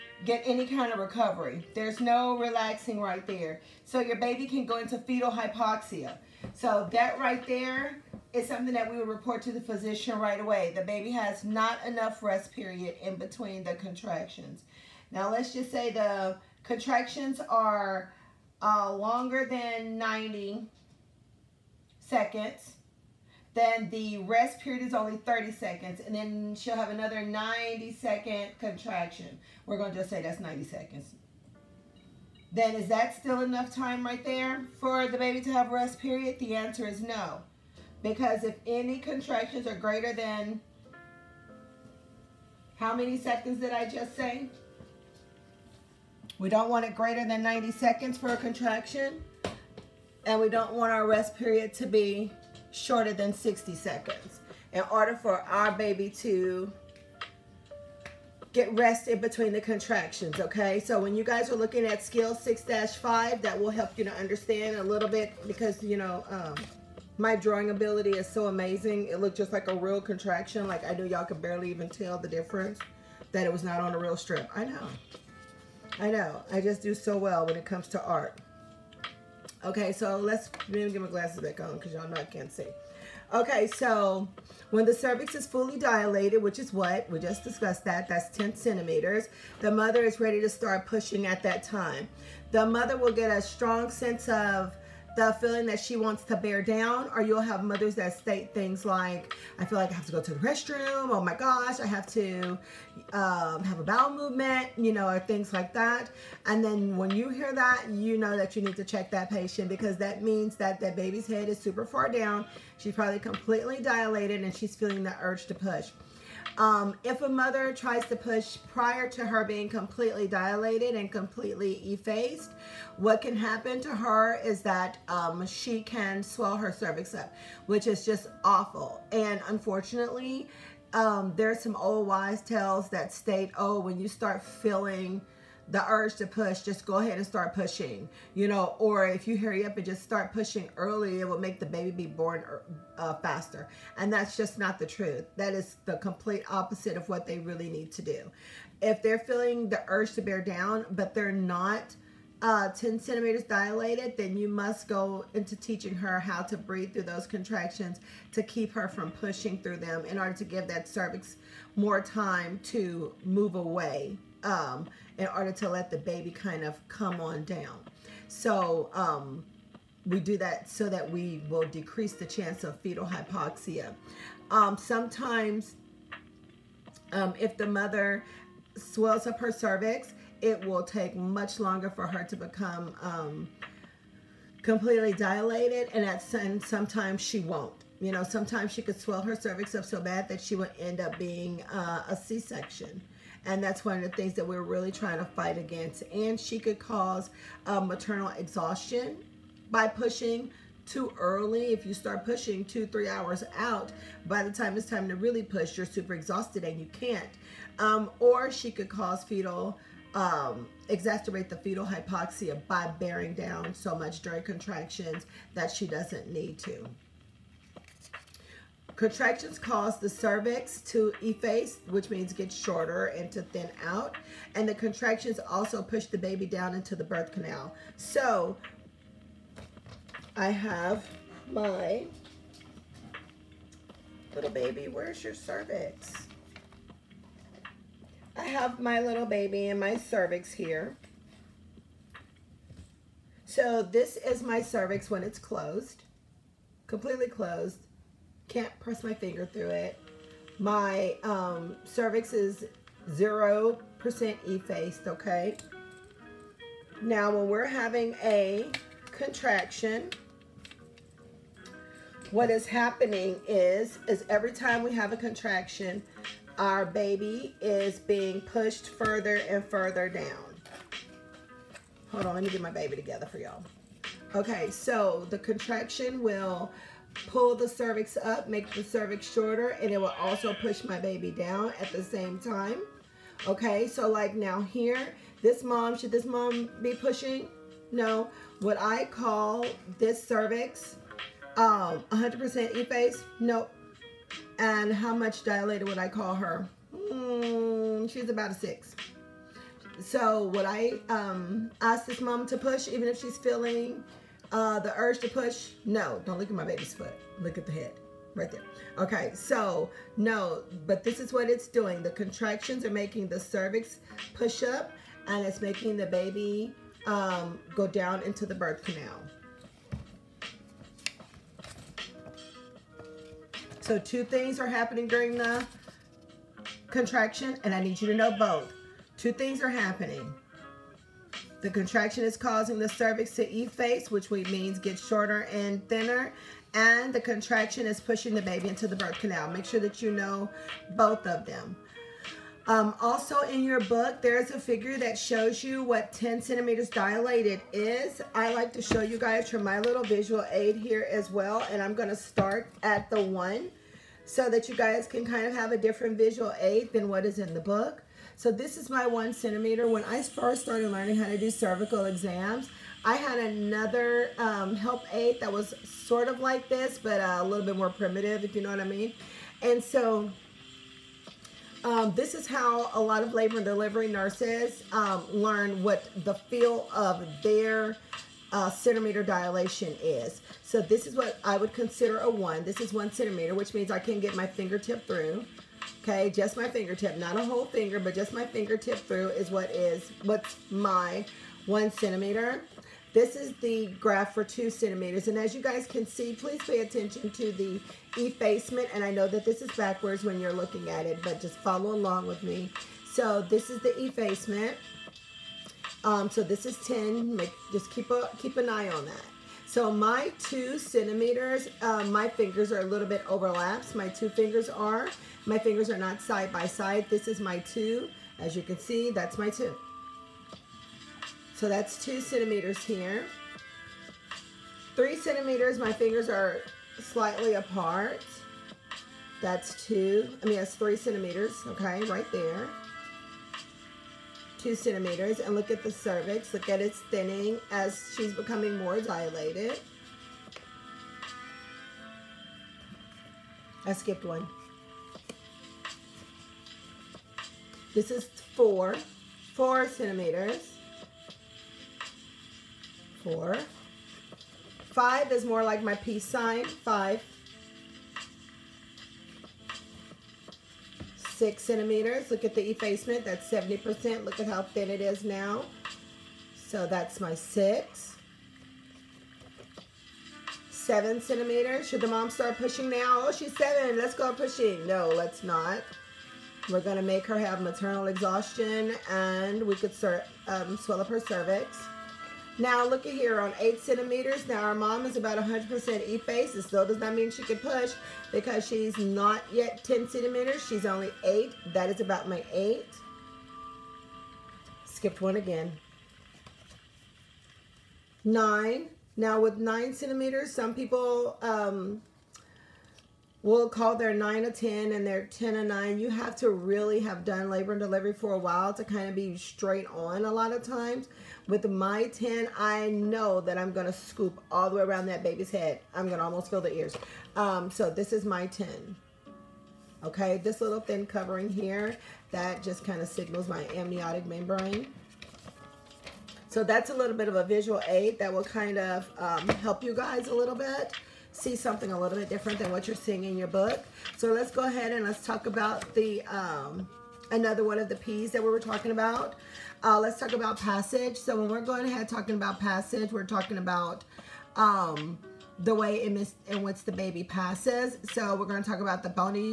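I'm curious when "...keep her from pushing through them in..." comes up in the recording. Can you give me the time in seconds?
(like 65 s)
158 s.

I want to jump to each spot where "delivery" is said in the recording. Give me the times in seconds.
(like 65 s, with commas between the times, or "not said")
373 s, 507 s.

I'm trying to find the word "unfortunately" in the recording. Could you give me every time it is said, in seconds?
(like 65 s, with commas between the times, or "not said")
129 s.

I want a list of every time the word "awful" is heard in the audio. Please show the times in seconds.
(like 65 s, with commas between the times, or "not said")
128 s.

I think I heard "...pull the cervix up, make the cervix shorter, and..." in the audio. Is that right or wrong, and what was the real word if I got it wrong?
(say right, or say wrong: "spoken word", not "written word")
right.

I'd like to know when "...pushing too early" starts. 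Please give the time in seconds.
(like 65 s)
199 s.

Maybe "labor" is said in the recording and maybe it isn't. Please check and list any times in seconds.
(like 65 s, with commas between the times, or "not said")
373 s, 507 s.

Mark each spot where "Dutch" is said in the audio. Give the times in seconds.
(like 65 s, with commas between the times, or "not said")
not said.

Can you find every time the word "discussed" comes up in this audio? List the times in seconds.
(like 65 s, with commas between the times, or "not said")
87 s.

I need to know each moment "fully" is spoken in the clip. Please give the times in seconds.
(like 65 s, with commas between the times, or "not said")
85 s.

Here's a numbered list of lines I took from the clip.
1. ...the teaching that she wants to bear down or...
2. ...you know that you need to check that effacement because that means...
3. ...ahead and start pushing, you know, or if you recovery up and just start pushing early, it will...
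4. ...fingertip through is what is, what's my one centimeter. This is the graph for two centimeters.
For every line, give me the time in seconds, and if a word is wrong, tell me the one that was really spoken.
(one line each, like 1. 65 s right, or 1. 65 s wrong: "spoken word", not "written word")
1. 95 s wrong: "feeling", not "teaching"
2. 107 s wrong: "patient", not "effacement"
3. 136 s wrong: "hurry", not "recovery"
4. 388 s right.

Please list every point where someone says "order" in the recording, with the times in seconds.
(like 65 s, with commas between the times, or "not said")
54 s, 160 s, 165 s.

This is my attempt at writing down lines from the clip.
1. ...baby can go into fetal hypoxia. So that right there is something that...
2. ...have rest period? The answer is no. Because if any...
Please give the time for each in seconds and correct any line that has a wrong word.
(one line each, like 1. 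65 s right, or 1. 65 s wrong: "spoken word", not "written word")
1. 4 s right
2. 35 s right.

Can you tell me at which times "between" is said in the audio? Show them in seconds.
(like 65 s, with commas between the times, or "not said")
13 s, 59 s.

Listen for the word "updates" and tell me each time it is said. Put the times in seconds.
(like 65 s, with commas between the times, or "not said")
not said.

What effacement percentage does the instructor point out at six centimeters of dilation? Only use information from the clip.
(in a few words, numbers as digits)
70%.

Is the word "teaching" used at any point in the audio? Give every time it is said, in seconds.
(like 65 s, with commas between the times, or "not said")
155 s.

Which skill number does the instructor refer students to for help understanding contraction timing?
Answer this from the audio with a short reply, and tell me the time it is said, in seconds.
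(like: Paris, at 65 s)
6-5, at 62 s.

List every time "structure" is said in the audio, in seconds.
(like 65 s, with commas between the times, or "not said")
not said.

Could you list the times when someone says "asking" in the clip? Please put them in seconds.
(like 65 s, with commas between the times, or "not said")
not said.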